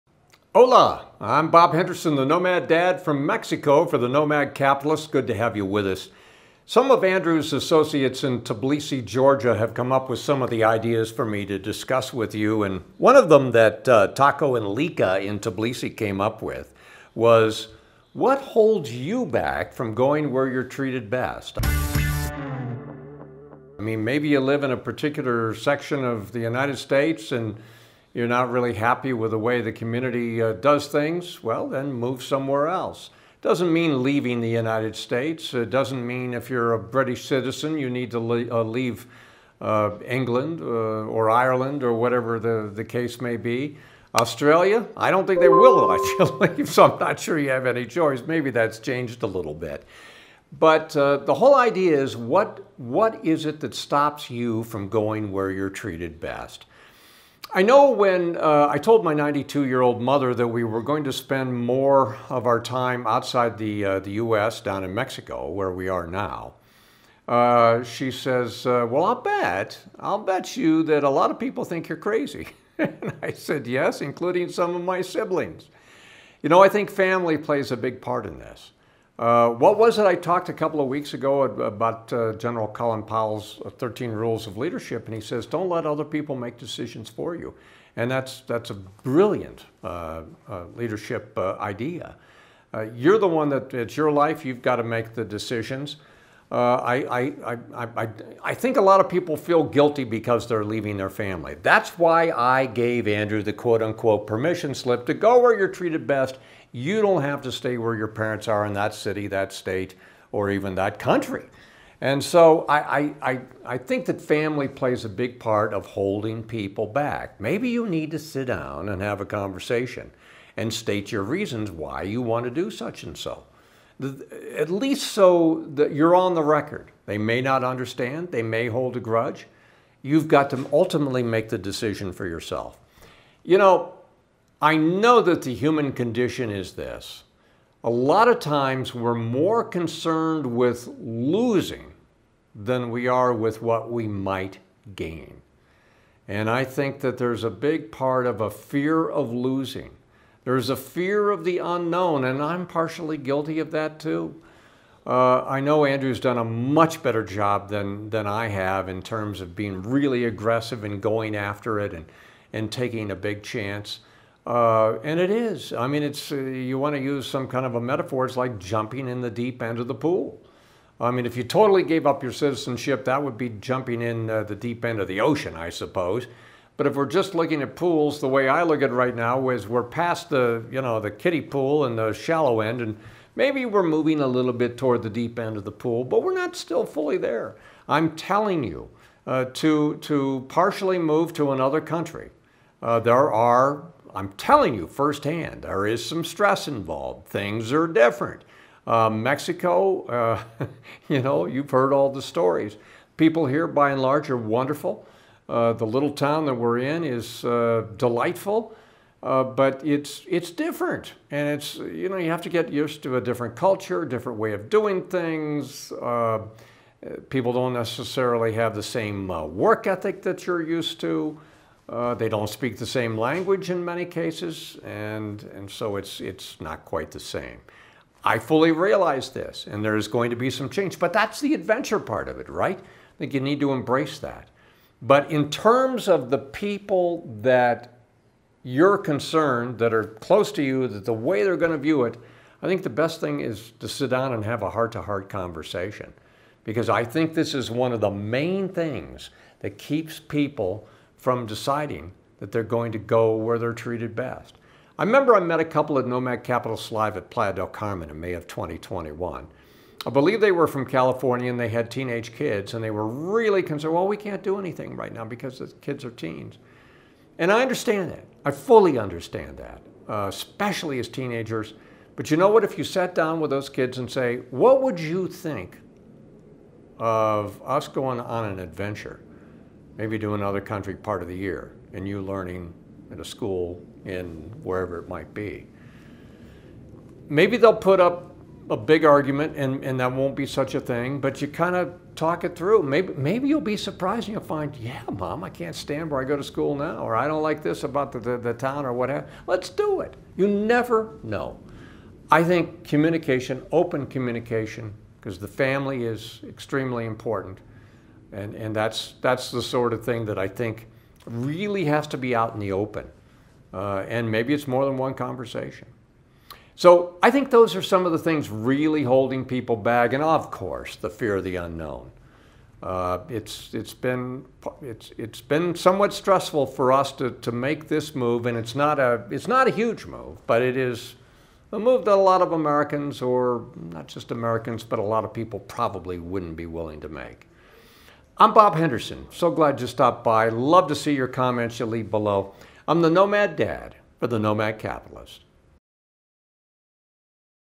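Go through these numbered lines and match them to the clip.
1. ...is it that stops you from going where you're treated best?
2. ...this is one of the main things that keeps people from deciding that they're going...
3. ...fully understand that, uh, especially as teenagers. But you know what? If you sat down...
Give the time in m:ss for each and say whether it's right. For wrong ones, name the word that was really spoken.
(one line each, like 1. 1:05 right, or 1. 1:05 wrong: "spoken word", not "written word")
1. 0:53 right
2. 4:07 right
3. 4:28 right.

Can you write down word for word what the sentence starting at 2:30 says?
There's a fear of the unknown, and I'm partially guilty of that too.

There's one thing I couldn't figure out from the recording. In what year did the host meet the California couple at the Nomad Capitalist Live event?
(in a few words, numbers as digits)
2021.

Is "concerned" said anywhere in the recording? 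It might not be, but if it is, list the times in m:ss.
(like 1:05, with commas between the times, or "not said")
2:19, 3:58, 4:23.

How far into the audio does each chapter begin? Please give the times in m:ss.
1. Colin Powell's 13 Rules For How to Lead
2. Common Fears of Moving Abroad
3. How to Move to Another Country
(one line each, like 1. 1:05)
1. 1:24
2. 1:59
3. 0:37.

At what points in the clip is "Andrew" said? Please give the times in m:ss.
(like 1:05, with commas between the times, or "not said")
0:07, 1:43, 2:35.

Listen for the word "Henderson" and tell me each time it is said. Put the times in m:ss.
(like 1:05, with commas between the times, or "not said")
0:01, 5:38.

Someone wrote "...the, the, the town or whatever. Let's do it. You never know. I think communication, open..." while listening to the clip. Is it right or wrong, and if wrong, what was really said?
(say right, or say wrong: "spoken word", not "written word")
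right.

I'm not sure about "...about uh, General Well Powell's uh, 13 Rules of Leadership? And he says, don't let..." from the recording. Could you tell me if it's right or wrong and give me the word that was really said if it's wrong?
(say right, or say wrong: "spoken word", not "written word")
wrong: "Colin", not "Well".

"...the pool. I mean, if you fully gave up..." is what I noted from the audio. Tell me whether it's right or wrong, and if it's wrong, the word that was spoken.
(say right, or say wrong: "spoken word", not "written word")
wrong: "totally", not "fully".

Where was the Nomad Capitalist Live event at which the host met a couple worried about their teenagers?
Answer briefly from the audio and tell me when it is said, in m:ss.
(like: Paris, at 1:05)
Playa del Carmen, at 4:17.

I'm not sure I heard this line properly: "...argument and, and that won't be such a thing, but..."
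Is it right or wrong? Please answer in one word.
right.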